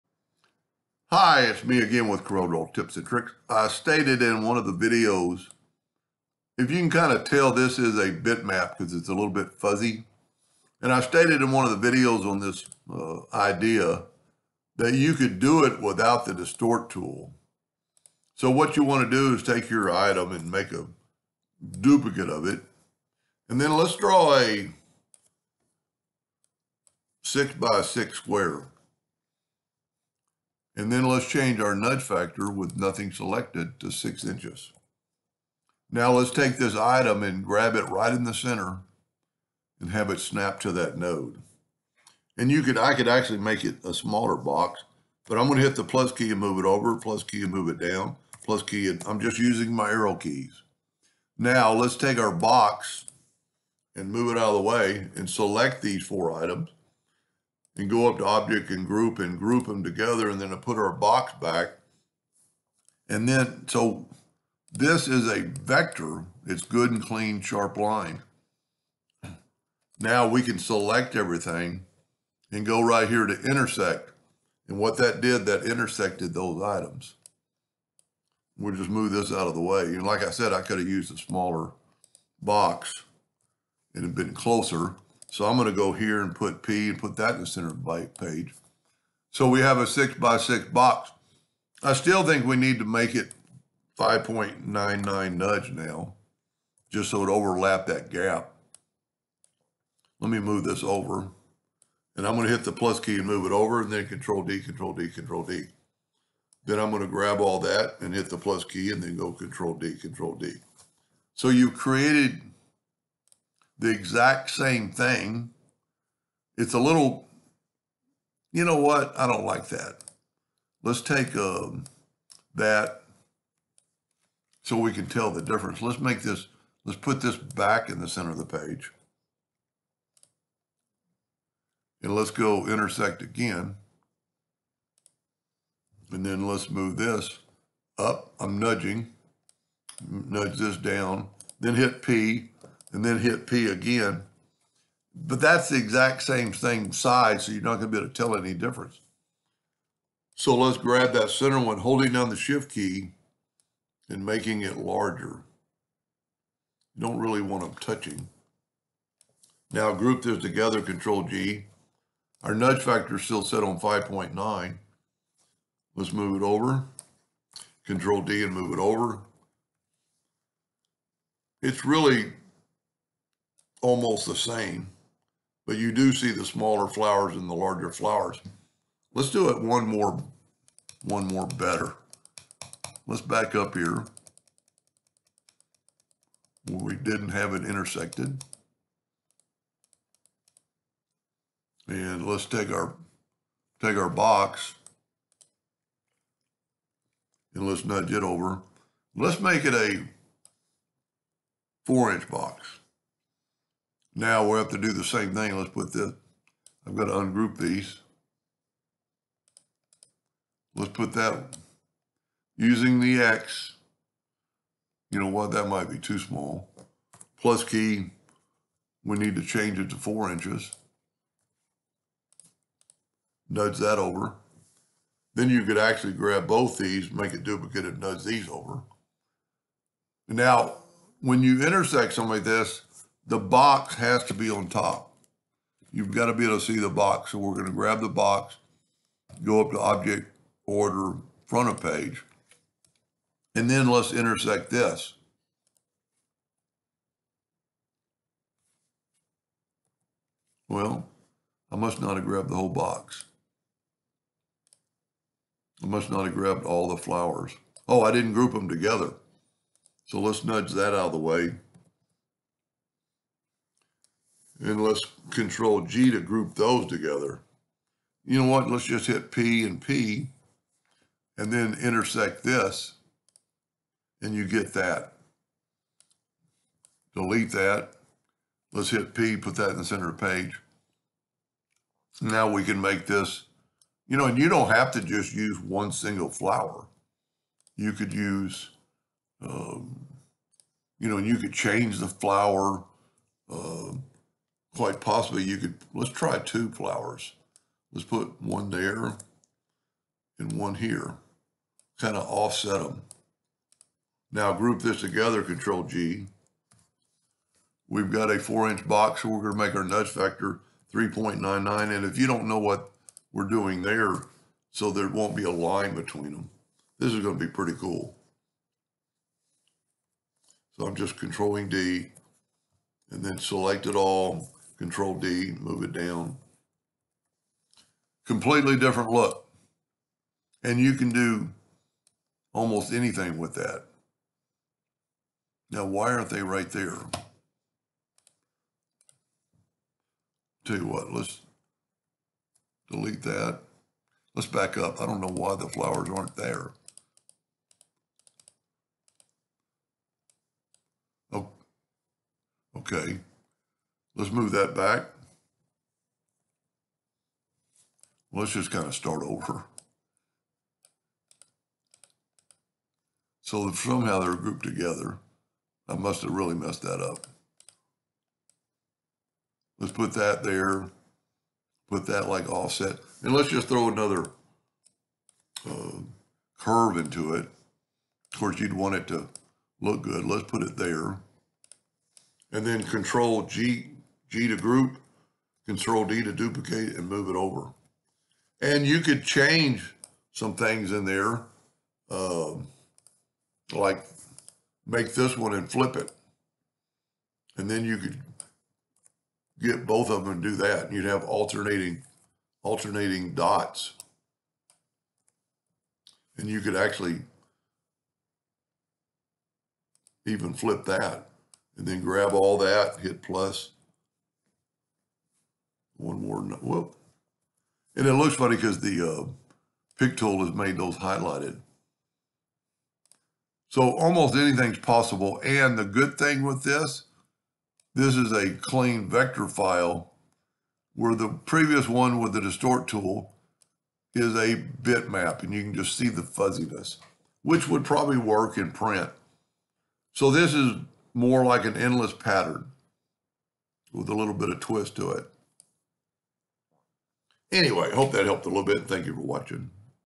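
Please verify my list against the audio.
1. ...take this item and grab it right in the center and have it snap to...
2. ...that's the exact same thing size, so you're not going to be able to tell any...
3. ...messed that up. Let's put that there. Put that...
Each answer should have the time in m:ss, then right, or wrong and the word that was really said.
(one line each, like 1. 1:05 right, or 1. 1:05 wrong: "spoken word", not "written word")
1. 0:36 right
2. 2:25 right
3. 6:06 right.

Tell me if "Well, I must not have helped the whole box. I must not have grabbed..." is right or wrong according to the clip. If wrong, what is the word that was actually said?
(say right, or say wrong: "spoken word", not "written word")
wrong: "grabbed", not "helped".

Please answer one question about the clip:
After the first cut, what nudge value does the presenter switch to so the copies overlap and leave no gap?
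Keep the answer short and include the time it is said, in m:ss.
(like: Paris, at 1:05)
5.99, at 1:33.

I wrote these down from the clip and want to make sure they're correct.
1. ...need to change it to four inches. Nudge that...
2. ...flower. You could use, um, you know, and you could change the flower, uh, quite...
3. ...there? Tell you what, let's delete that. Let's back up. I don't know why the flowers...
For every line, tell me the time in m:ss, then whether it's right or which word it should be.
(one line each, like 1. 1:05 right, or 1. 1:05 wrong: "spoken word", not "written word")
1. 3:39 right
2. 4:46 right
3. 5:36 right.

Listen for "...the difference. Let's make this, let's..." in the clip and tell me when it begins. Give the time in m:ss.
2:05.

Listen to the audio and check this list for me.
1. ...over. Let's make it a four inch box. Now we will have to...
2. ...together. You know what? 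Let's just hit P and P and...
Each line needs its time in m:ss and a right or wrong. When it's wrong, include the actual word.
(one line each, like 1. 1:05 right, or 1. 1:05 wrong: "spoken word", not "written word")
1. 3:18 right
2. 4:26 right.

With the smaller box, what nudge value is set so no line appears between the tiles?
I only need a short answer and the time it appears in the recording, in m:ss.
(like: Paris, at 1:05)
3.99, at 5:10.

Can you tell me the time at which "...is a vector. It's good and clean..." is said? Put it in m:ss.
1:05.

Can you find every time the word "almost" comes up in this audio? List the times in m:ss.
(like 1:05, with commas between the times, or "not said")
2:53, 5:32, 7:03.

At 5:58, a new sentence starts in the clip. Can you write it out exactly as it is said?
Let's just kind of start over.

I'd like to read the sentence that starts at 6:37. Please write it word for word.
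And then you could get both of them and do that.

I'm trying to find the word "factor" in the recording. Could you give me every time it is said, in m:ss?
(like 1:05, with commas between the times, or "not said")
0:32, 2:42, 5:10.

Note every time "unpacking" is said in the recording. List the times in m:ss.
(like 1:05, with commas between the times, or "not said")
not said.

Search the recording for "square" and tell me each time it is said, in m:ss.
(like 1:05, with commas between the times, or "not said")
0:28.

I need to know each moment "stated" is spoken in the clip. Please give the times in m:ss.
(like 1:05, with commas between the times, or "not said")
0:03, 0:11.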